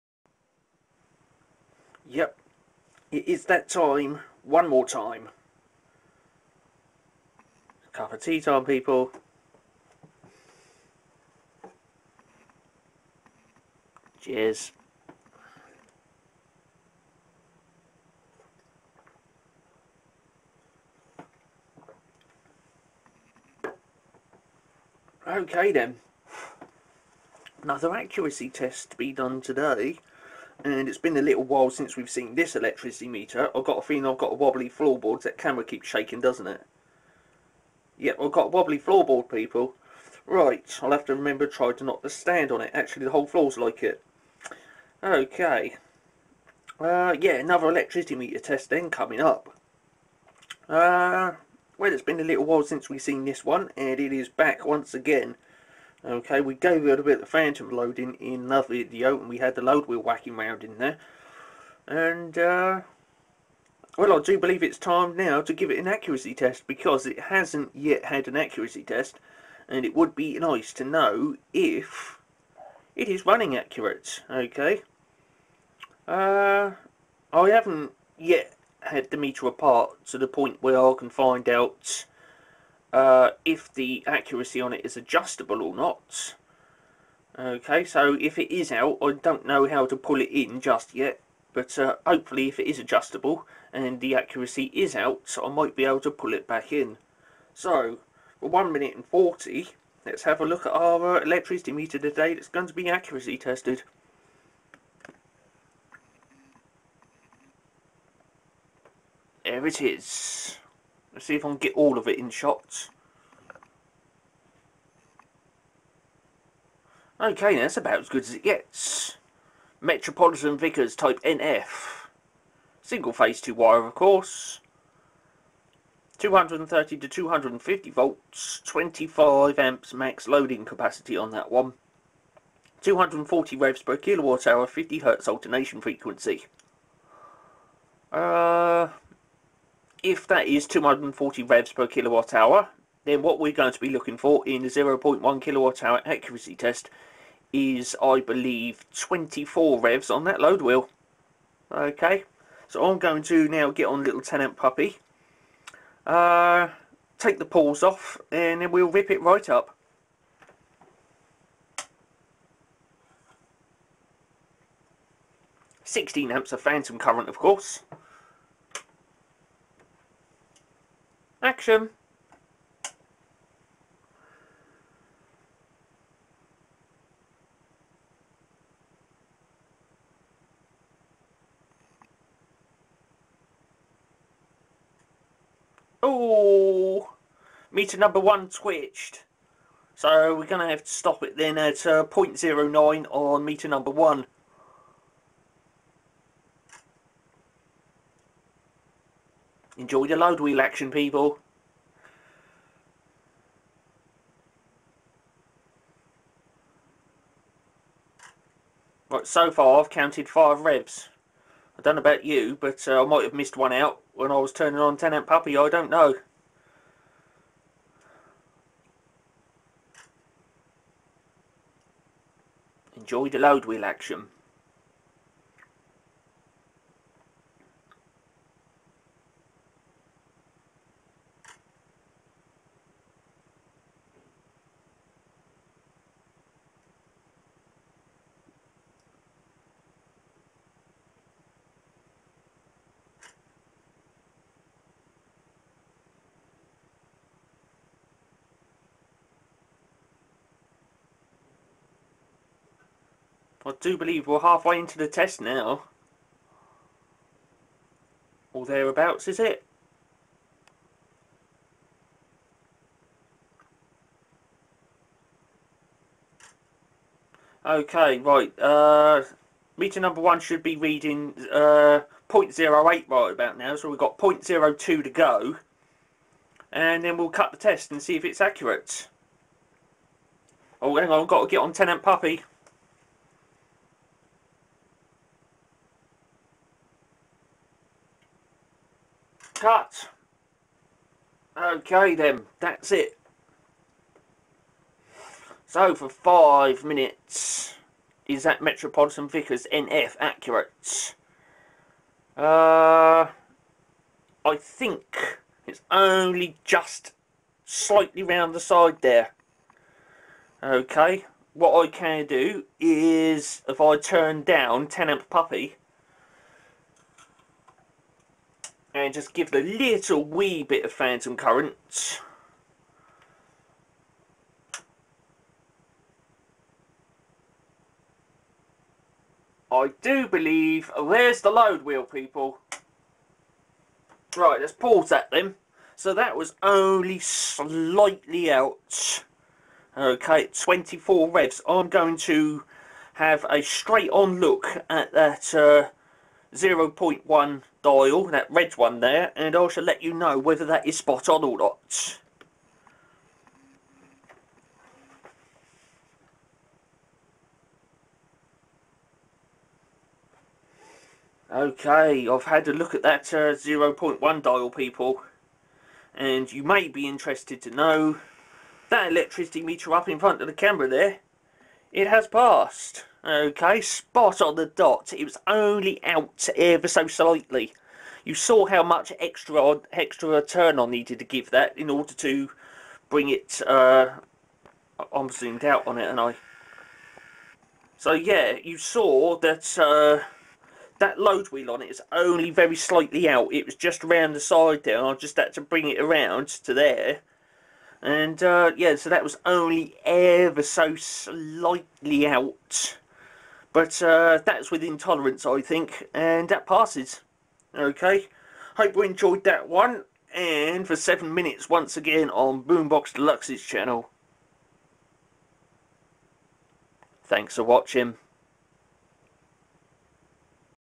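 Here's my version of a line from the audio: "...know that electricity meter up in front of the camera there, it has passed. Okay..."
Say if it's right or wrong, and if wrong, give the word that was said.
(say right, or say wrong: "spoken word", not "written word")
right.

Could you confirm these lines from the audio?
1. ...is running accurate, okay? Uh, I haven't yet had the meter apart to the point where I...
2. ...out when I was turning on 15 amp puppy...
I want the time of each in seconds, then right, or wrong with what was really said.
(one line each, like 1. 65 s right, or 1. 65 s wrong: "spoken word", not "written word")
1. 73 s right
2. 213 s wrong: "10", not "15".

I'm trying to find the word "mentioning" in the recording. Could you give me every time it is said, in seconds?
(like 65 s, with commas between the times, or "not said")
not said.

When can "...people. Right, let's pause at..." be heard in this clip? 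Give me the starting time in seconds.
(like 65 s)
332 s.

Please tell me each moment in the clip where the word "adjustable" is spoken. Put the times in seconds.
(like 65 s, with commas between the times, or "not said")
84 s, 92 s.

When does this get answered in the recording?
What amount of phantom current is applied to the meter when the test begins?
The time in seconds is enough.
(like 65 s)
165 s.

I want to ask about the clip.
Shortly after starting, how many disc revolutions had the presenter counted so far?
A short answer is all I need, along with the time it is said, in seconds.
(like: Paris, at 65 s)
5, at 210 s.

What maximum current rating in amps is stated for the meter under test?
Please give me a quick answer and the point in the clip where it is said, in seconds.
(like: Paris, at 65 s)
25 amps, at 128 s.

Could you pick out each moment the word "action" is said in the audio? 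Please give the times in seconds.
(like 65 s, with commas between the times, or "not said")
171 s, 200 s, 223 s.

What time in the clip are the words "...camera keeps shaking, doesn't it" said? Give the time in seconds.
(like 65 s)
35 s.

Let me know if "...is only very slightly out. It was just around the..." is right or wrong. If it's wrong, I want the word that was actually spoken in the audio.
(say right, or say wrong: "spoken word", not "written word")
right.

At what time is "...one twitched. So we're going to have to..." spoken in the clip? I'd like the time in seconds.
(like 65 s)
188 s.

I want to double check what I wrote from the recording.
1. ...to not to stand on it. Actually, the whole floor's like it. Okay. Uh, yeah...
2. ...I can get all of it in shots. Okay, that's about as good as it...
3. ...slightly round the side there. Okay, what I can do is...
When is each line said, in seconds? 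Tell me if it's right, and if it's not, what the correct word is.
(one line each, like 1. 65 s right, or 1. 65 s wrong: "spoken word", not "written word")
1. 41 s right
2. 111 s right
3. 307 s right.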